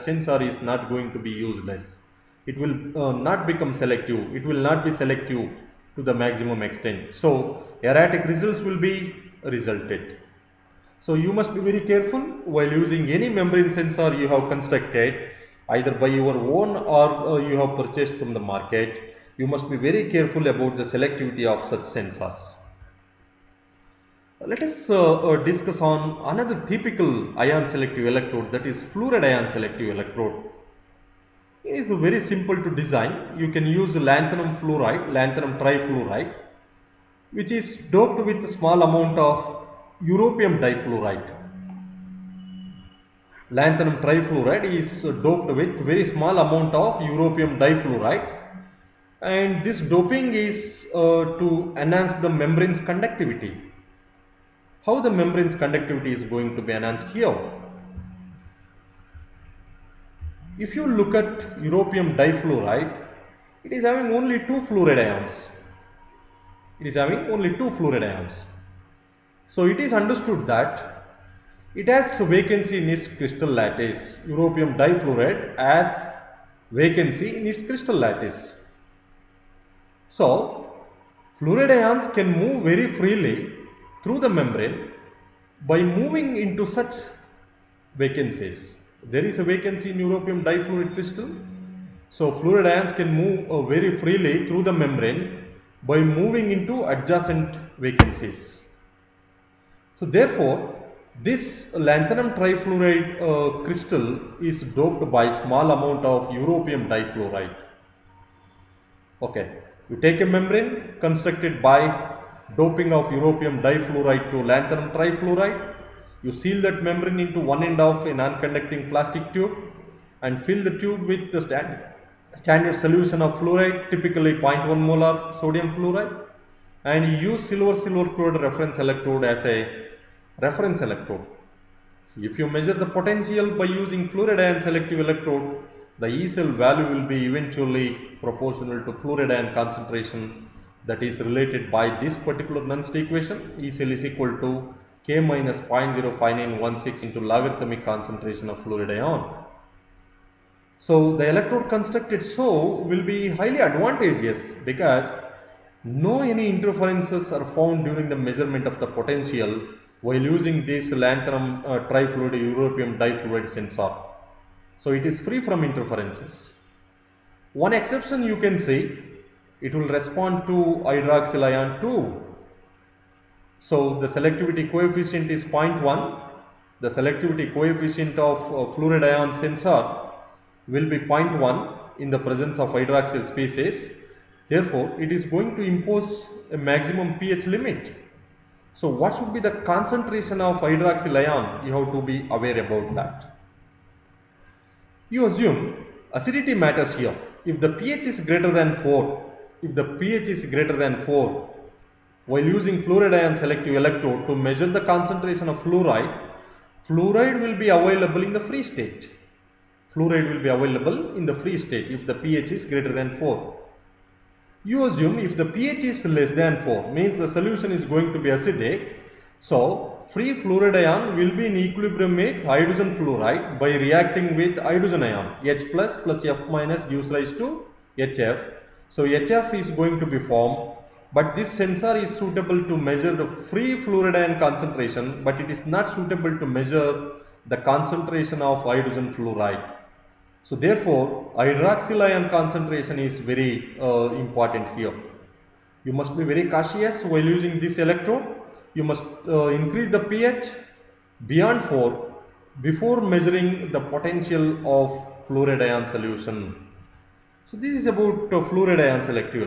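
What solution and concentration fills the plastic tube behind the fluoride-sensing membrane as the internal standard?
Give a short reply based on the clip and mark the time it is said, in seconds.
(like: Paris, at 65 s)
0.1 molar sodium fluoride, at 124 s.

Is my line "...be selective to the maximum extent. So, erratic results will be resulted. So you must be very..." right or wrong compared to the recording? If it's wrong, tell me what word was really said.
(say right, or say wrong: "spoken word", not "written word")
right.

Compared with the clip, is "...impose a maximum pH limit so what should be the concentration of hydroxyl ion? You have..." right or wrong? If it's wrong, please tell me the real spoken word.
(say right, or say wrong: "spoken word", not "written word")
right.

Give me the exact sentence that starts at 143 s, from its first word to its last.
E cell is equal to K minus 0.05916 into logarithmic concentration of fluoride ion.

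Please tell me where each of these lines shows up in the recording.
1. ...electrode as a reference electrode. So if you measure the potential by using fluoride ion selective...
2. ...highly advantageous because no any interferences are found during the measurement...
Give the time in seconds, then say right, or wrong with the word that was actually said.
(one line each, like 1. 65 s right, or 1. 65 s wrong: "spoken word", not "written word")
1. 128 s right
2. 153 s right.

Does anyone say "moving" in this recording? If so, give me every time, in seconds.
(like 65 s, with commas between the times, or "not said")
85 s, 95 s.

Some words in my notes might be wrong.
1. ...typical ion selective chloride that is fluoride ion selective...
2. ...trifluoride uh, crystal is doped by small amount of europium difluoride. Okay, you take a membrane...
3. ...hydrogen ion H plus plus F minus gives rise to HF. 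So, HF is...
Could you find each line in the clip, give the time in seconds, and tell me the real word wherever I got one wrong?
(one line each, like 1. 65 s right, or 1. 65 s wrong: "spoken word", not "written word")
1. 26 s wrong: "electrode", not "chloride"
2. 102 s right
3. 224 s right.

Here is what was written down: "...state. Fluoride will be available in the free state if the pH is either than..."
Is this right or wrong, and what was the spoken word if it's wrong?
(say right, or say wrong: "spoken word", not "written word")
wrong: "greater", not "either".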